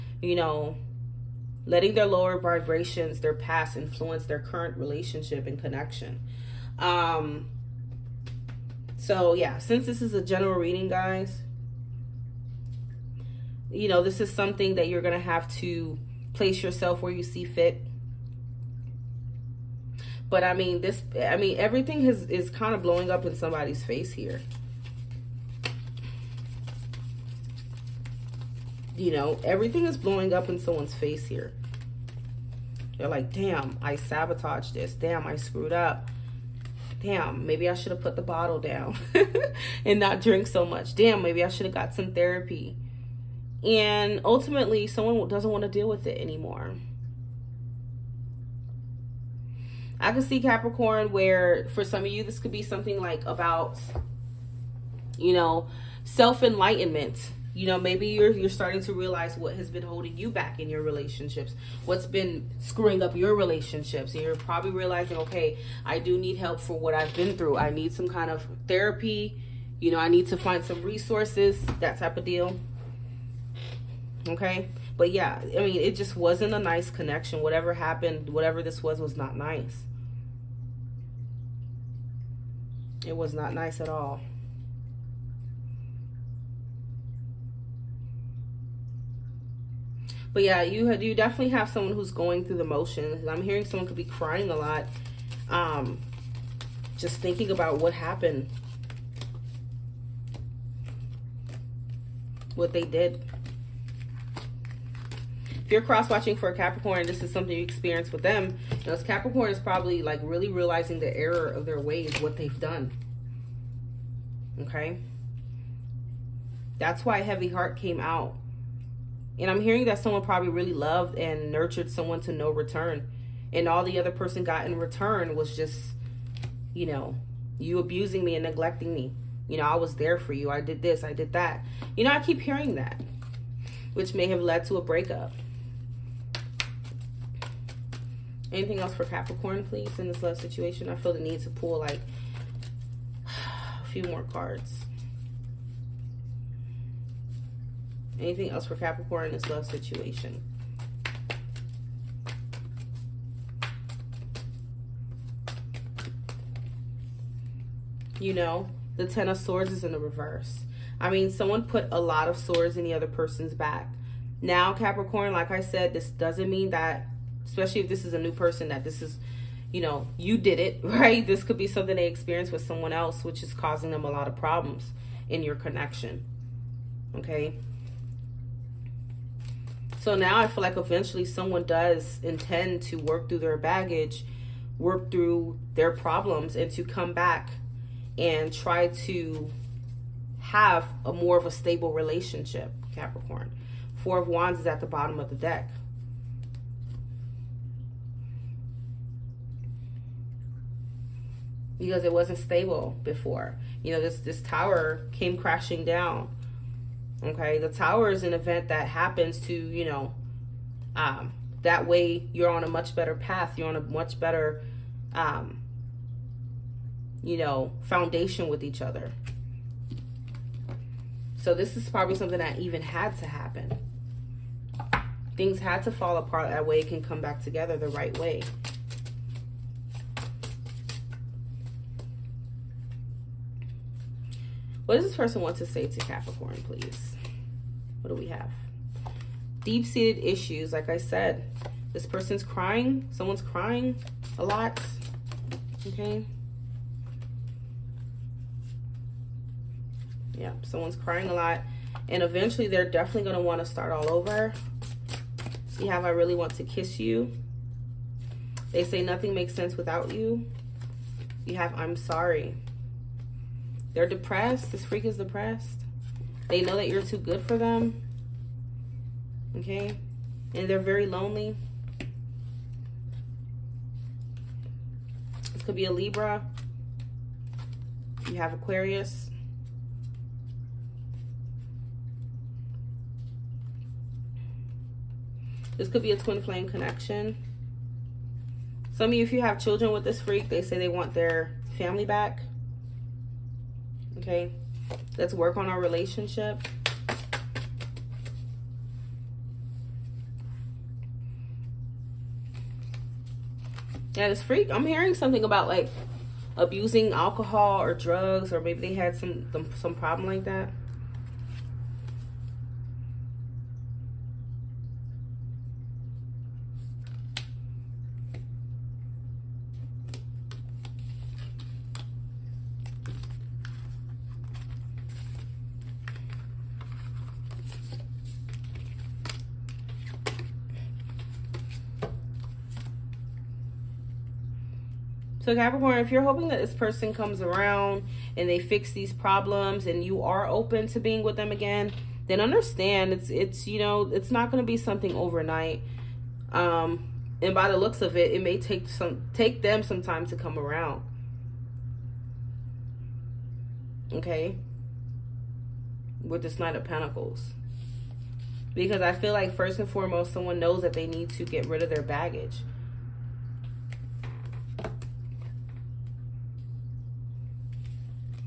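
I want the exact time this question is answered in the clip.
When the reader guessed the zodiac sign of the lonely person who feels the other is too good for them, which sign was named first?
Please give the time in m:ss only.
4:35.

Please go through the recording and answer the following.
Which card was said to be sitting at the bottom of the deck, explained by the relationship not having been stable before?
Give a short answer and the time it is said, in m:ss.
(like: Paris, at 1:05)
Four of Wands, at 3:13.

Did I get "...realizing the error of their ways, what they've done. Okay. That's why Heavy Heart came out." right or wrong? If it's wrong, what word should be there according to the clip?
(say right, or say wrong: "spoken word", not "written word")
right.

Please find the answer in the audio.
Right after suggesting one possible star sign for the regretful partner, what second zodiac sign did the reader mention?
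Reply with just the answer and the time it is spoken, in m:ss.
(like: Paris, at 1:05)
Aquarius, at 4:38.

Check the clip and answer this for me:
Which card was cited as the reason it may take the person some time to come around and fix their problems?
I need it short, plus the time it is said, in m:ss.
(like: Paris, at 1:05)
Knight of Pentacles, at 5:56.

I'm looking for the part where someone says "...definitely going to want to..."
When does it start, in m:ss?
4:12.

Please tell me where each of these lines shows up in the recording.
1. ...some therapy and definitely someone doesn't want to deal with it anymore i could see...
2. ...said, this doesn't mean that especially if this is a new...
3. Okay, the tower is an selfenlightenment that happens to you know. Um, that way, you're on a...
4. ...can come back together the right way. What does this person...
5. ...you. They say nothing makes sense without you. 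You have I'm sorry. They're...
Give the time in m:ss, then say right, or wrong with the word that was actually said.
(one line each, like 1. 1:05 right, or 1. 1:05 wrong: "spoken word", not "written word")
1. 0:41 wrong: "ultimately", not "definitely"
2. 2:45 right
3. 3:27 wrong: "event", not "selfenlightenment"
4. 3:46 right
5. 4:16 right.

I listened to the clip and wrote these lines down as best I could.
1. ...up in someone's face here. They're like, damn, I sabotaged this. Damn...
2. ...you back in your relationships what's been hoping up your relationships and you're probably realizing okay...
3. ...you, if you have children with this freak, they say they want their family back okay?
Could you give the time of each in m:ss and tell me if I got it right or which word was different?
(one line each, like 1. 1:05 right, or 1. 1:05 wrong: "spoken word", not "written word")
1. 0:30 right
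2. 1:00 wrong: "screwing", not "hoping"
3. 4:49 right.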